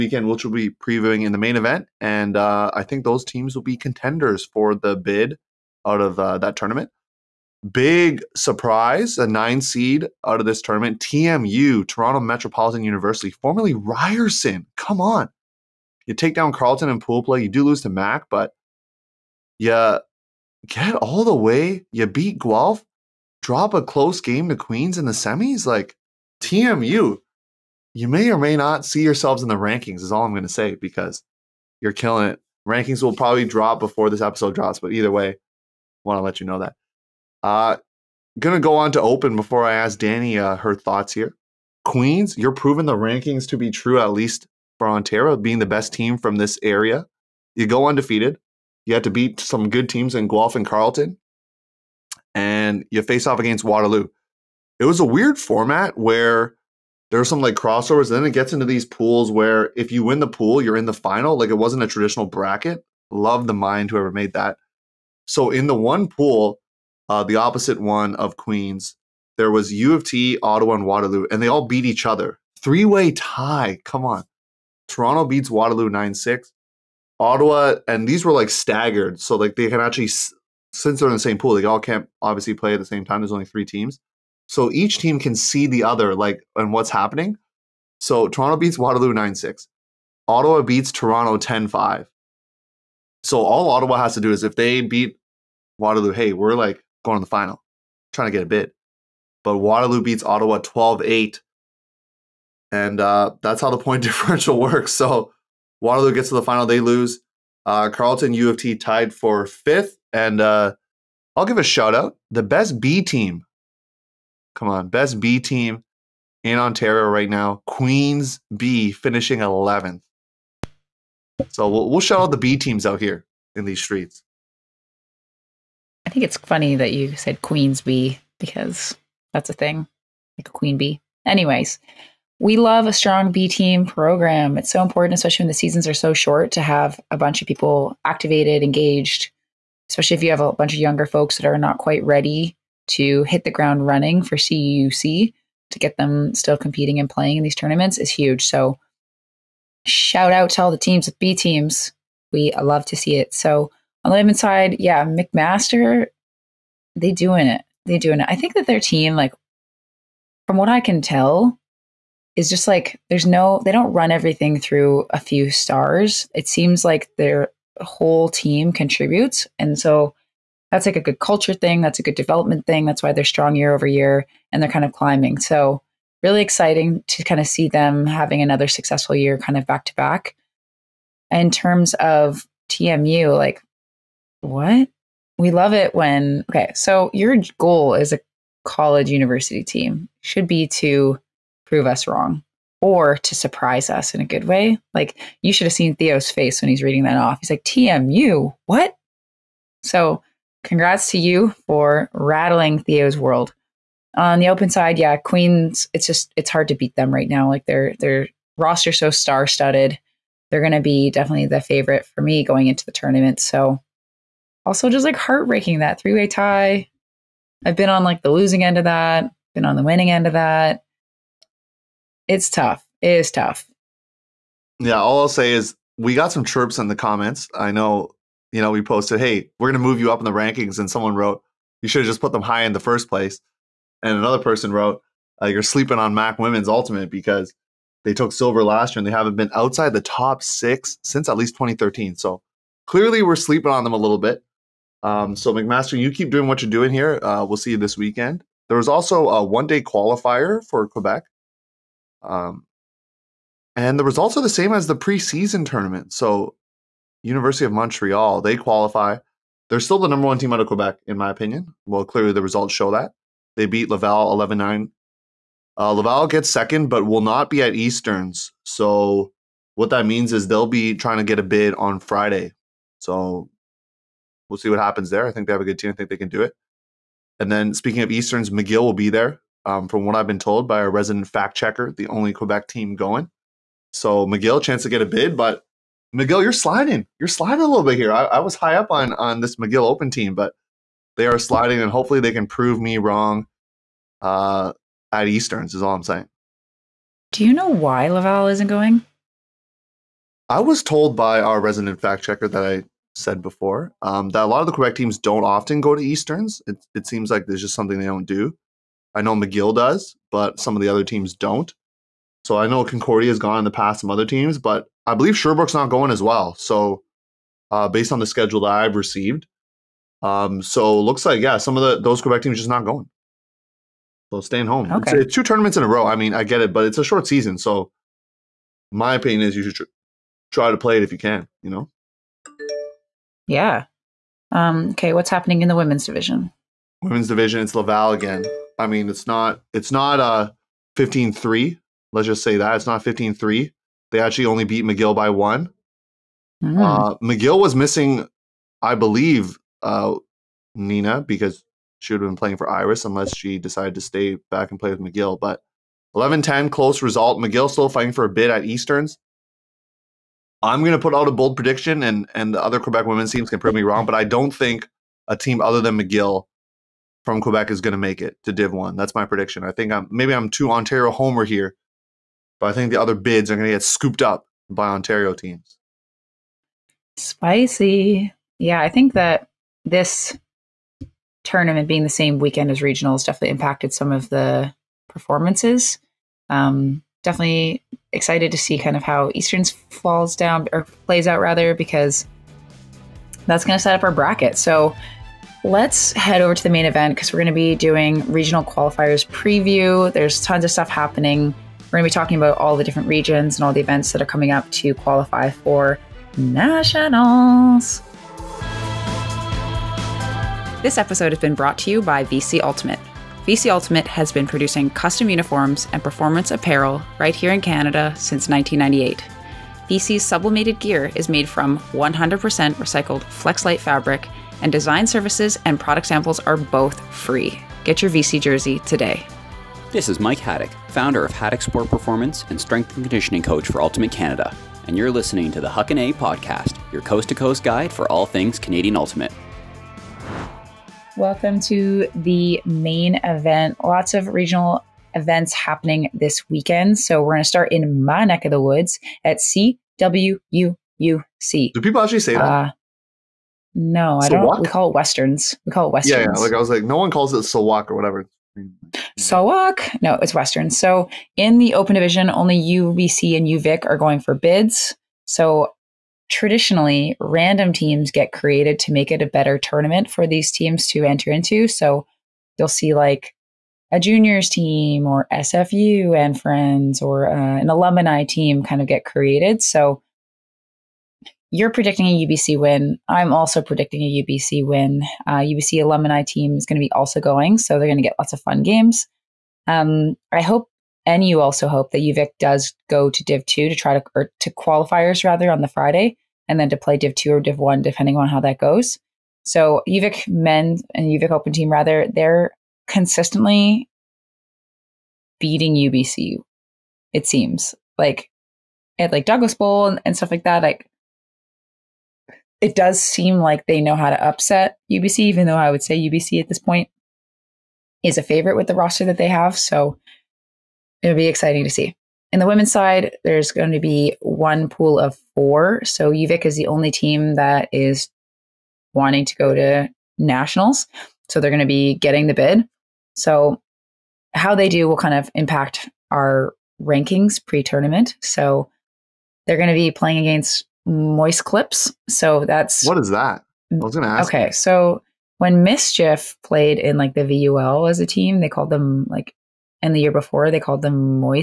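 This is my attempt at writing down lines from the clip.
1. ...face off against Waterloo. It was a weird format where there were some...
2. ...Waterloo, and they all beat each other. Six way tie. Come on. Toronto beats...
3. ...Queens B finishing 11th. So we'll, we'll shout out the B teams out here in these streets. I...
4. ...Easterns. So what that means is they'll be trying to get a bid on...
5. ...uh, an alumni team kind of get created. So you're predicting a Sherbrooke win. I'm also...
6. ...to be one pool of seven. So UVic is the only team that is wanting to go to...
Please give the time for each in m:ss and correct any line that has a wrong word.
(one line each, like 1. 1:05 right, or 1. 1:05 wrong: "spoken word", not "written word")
1. 0:53 right
2. 1:10 wrong: "Three", not "Six"
3. 1:57 right
4. 4:27 right
5. 7:57 wrong: "UBC", not "Sherbrooke"
6. 8:43 wrong: "four", not "seven".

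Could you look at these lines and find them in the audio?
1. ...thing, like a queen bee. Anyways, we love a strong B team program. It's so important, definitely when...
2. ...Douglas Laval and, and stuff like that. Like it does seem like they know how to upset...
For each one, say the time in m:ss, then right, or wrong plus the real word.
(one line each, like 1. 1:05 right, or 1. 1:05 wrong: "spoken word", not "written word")
1. 2:09 wrong: "especially", not "definitely"
2. 8:29 wrong: "Bowl", not "Laval".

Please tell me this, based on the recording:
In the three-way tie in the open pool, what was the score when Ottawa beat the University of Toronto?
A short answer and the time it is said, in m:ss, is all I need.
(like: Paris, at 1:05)
10-5, at 1:31.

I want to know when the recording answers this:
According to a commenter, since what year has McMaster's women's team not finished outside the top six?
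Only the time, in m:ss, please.
4:01.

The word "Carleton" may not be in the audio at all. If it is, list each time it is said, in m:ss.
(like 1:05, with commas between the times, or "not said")
0:16, 0:50, 1:47.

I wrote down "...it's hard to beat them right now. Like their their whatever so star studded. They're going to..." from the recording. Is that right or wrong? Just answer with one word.
wrong.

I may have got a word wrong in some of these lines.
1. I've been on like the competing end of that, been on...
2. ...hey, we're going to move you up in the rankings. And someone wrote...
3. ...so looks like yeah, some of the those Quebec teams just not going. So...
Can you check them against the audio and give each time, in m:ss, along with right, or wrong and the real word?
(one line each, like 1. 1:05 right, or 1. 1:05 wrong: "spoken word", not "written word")
1. 3:37 wrong: "losing", not "competing"
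2. 3:49 right
3. 5:20 right.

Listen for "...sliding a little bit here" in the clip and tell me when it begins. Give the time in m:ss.
4:47.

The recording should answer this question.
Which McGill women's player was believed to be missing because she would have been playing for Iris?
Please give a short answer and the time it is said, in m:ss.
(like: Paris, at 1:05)
Nina, at 5:50.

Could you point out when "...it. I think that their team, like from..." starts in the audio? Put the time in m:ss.
2:38.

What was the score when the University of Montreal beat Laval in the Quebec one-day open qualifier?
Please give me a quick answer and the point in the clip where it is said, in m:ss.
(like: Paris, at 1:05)
11-9, at 4:24.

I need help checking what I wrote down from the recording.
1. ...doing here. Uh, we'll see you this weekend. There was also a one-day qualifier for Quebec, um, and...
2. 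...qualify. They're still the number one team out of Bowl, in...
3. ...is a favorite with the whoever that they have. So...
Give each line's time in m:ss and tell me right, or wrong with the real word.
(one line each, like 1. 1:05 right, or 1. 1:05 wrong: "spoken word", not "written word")
1. 4:06 right
2. 4:18 wrong: "Quebec", not "Bowl"
3. 8:38 wrong: "roster", not "whoever".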